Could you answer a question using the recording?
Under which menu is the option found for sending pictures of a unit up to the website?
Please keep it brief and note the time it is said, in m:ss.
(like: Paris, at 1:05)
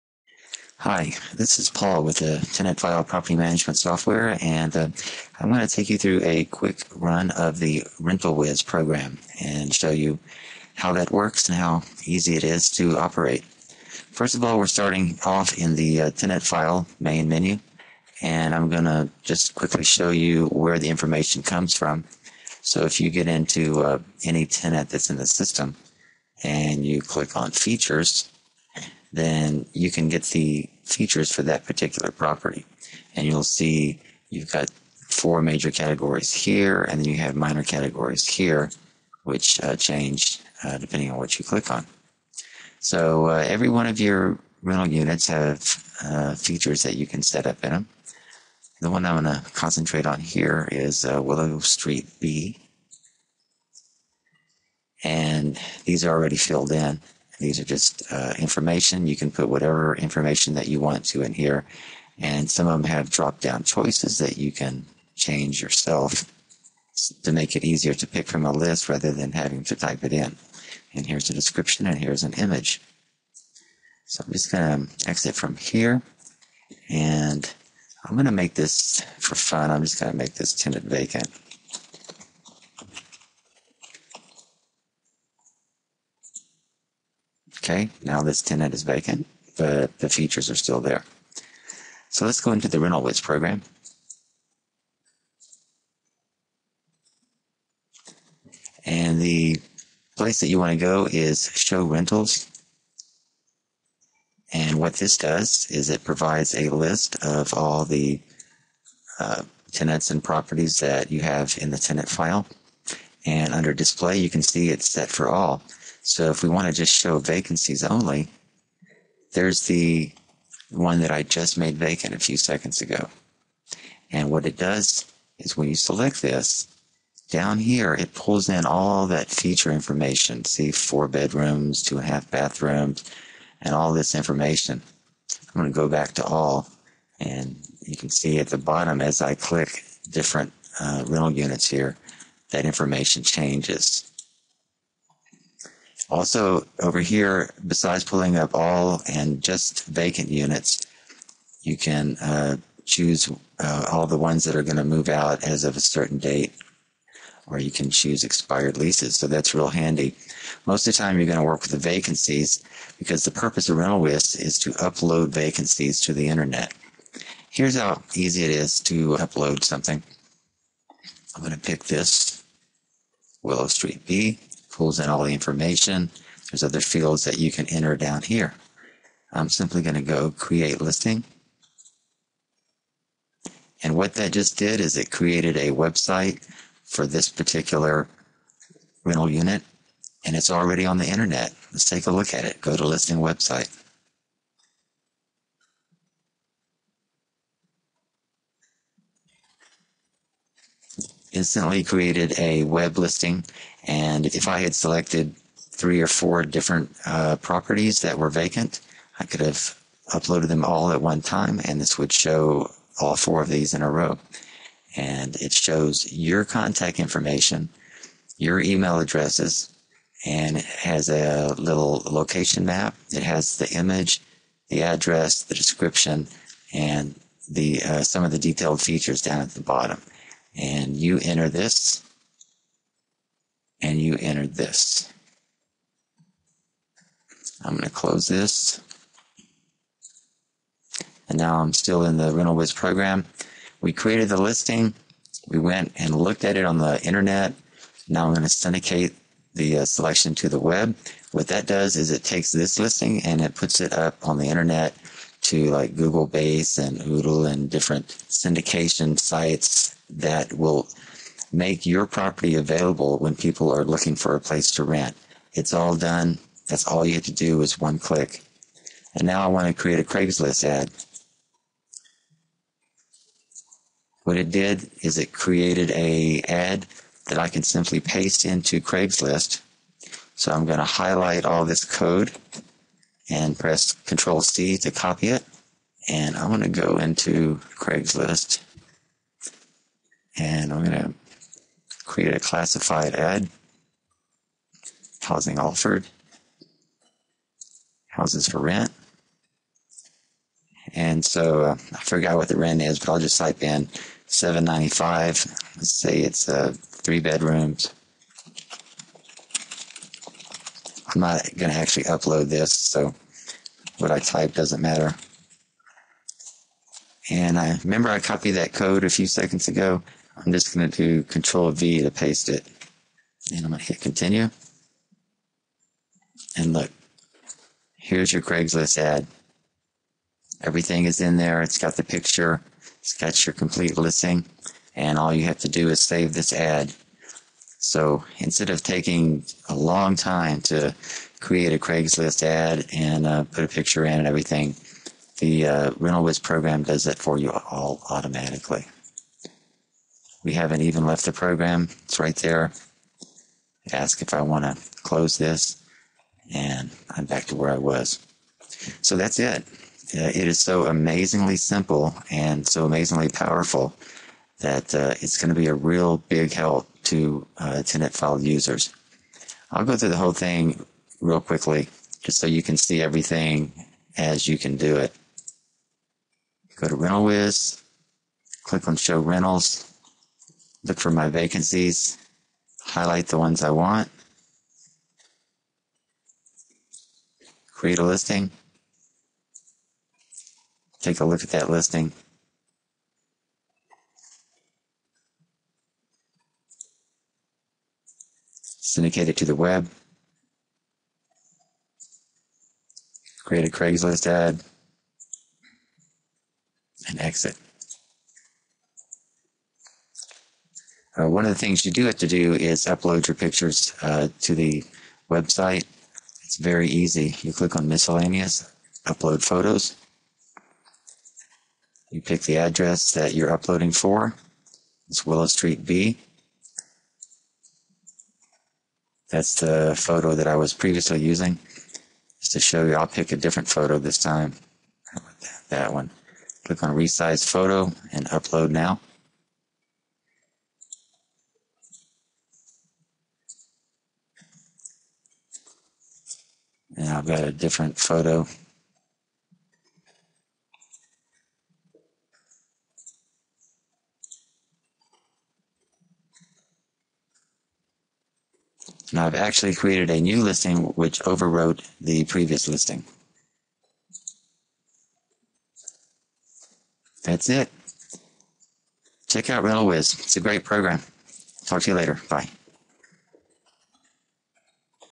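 Miscellaneous, at 6:57.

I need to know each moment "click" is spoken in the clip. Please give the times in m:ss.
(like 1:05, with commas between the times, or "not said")
0:27, 0:41, 2:19, 4:27, 6:18, 6:57, 7:16.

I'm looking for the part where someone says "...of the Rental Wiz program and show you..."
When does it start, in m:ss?
0:07.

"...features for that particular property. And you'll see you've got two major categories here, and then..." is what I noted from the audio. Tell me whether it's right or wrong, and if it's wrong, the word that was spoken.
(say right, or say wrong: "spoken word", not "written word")
wrong: "four", not "two".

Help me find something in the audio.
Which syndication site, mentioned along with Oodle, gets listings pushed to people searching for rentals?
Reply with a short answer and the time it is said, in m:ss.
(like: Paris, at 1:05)
Google Base, at 4:15.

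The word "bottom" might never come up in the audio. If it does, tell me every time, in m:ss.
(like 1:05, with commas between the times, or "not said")
2:18, 3:49.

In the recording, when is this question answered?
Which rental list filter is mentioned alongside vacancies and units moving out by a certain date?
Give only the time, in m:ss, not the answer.
2:38.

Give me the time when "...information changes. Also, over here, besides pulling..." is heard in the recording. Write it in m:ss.
2:22.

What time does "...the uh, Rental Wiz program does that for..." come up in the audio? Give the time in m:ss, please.
5:45.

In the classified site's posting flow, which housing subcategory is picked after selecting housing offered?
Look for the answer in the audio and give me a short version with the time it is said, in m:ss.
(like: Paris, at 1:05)
Houses for rent, at 4:58.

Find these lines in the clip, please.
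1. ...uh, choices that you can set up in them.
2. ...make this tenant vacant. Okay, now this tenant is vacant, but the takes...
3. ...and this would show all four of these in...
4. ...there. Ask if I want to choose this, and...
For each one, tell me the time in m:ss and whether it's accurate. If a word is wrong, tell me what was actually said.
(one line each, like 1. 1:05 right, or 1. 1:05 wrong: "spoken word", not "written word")
1. 0:46 wrong: "features", not "choices"
2. 1:20 wrong: "features", not "takes"
3. 3:31 right
4. 5:52 wrong: "close", not "choose".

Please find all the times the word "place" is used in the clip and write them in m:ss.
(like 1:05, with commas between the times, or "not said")
1:40, 4:24.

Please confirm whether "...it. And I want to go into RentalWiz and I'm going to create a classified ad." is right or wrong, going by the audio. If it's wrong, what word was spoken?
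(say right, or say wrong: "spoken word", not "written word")
wrong: "Craigslist", not "RentalWiz".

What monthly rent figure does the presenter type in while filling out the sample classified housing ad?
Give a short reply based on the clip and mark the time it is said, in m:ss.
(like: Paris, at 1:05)
795, at 5:04.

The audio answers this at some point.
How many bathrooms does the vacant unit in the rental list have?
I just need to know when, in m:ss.
2:11.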